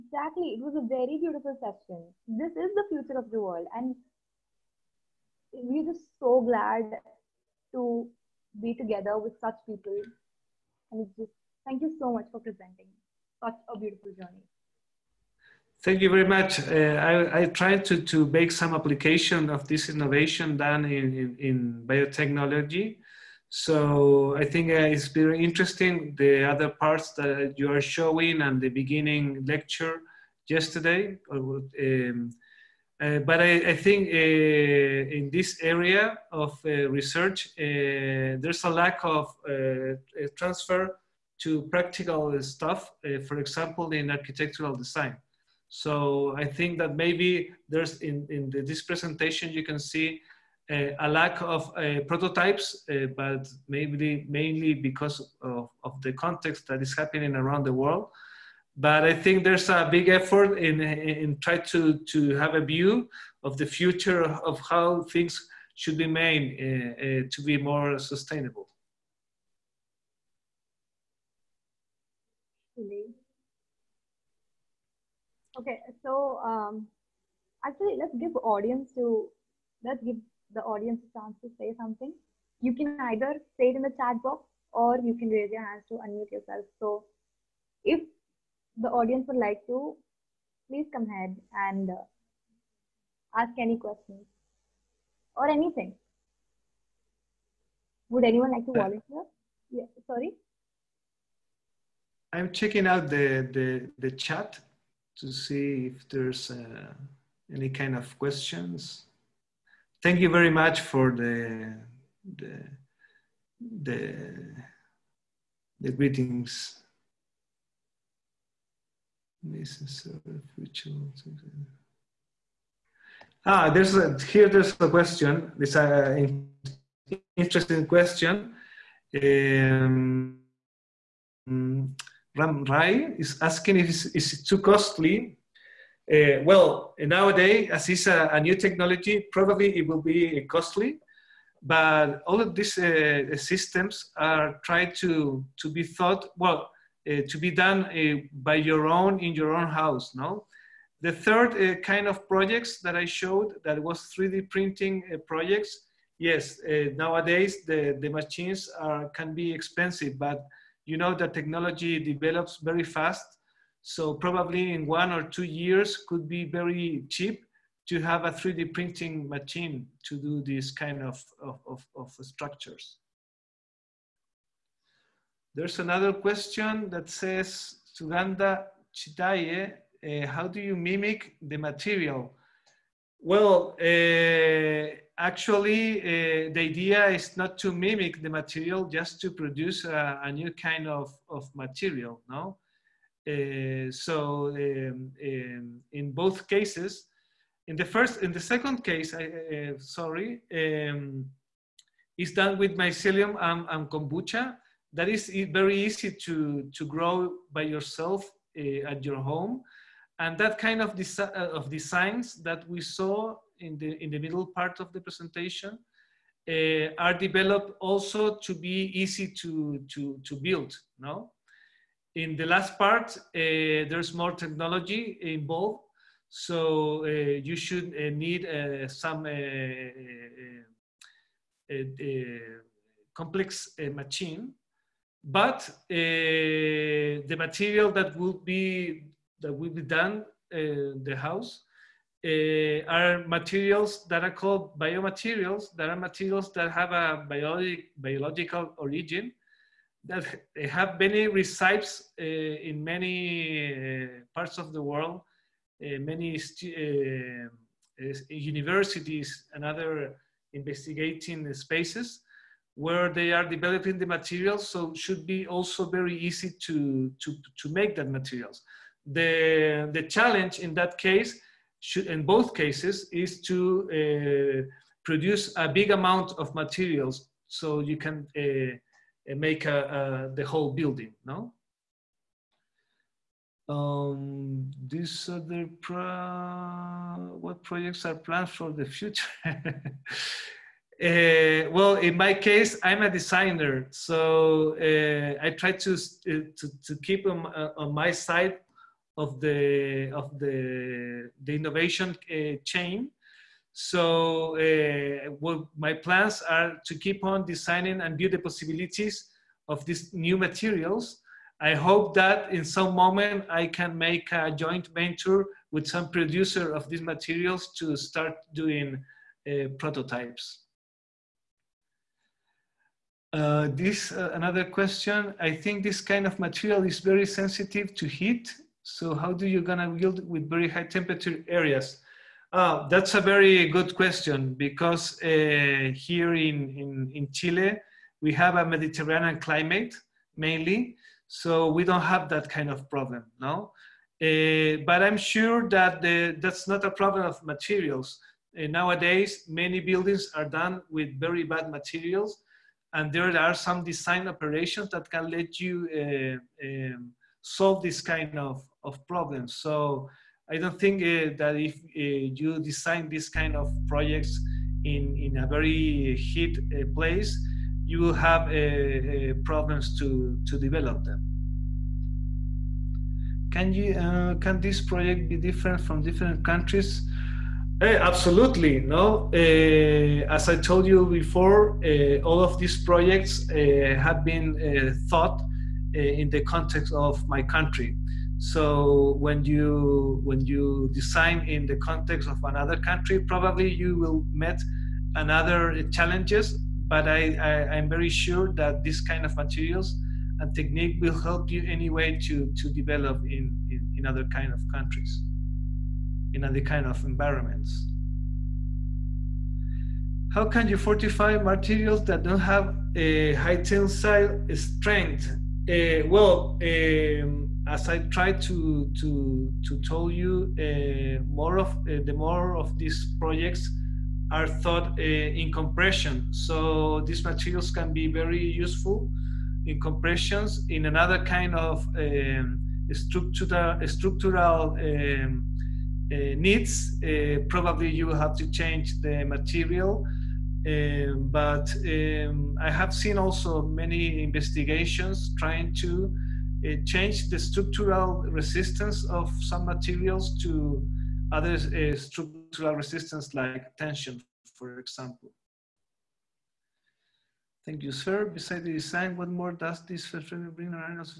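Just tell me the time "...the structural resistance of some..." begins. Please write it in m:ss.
7:27.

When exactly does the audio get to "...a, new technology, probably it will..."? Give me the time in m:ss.
2:18.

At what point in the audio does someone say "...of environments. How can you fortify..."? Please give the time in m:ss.
6:46.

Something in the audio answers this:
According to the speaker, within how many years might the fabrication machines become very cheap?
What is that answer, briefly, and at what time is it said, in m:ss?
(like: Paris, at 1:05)
one or two years, at 2:44.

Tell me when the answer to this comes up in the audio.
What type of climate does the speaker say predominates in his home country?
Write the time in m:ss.
5:38.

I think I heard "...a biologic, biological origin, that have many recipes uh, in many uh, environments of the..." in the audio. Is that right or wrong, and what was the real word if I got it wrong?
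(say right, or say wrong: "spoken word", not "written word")
wrong: "parts", not "environments".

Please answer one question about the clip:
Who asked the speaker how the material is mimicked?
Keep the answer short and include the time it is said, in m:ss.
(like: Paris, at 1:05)
Suganda Chitaye, at 2:57.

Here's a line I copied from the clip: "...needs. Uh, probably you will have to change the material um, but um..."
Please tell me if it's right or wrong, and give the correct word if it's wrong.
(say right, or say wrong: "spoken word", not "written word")
right.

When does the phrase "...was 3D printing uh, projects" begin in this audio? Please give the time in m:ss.
2:33.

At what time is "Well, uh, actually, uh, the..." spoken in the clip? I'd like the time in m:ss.
3:03.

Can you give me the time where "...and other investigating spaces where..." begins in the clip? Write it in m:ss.
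4:19.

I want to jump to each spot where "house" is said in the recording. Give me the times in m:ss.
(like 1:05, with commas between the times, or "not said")
2:29, 4:01.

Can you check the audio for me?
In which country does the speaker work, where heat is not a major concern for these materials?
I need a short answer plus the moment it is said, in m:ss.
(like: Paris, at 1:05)
Chile, at 5:37.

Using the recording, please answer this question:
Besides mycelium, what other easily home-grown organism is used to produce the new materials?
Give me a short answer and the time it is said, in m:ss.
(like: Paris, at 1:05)
kombucha, at 3:23.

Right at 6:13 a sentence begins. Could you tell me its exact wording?
Can, you, can this project be different from different countries?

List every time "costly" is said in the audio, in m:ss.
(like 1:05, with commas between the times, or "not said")
2:14, 2:20.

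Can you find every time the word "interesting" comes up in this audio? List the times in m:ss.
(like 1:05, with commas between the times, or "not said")
0:25, 2:07.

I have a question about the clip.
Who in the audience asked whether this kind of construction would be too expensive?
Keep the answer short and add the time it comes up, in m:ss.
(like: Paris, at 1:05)
Ram Rai, at 2:12.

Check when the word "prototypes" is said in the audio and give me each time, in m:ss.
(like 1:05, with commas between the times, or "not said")
0:52, 5:19.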